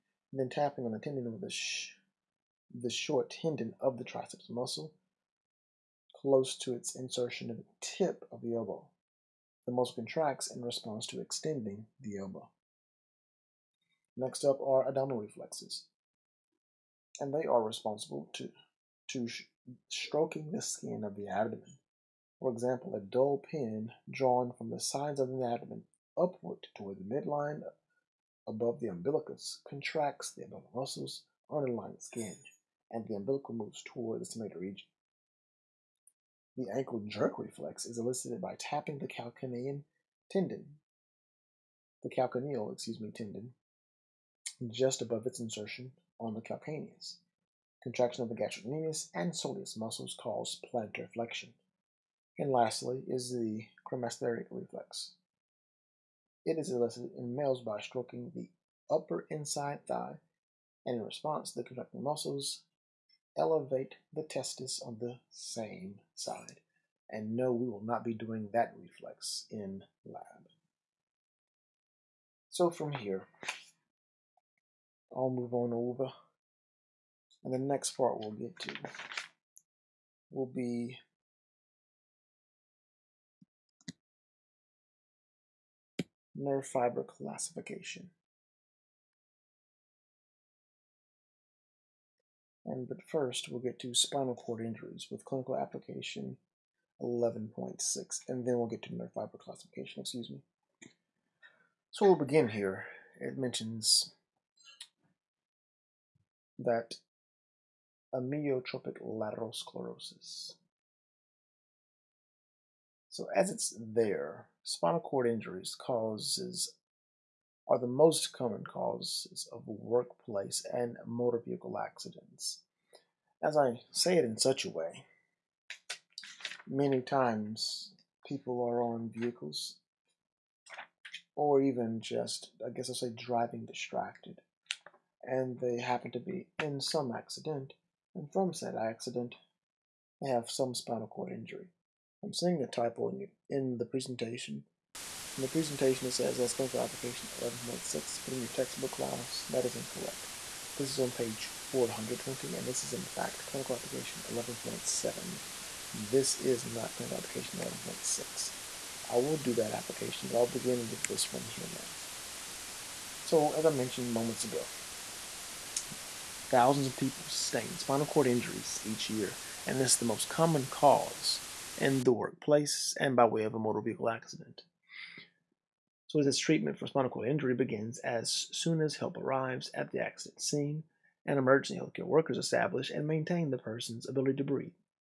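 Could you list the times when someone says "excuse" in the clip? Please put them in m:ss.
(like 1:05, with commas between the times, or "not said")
0:42, 1:40.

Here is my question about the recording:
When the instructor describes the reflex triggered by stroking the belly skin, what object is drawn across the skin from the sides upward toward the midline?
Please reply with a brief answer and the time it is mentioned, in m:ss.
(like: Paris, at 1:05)
dull pin, at 0:22.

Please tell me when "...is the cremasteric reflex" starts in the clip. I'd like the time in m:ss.
0:53.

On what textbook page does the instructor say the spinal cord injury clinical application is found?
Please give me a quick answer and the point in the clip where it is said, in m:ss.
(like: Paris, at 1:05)
420, at 2:31.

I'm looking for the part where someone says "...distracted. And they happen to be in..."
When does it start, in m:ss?
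2:13.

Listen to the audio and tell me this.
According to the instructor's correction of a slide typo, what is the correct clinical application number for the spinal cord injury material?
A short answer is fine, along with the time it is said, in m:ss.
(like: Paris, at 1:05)
11.7, at 2:34.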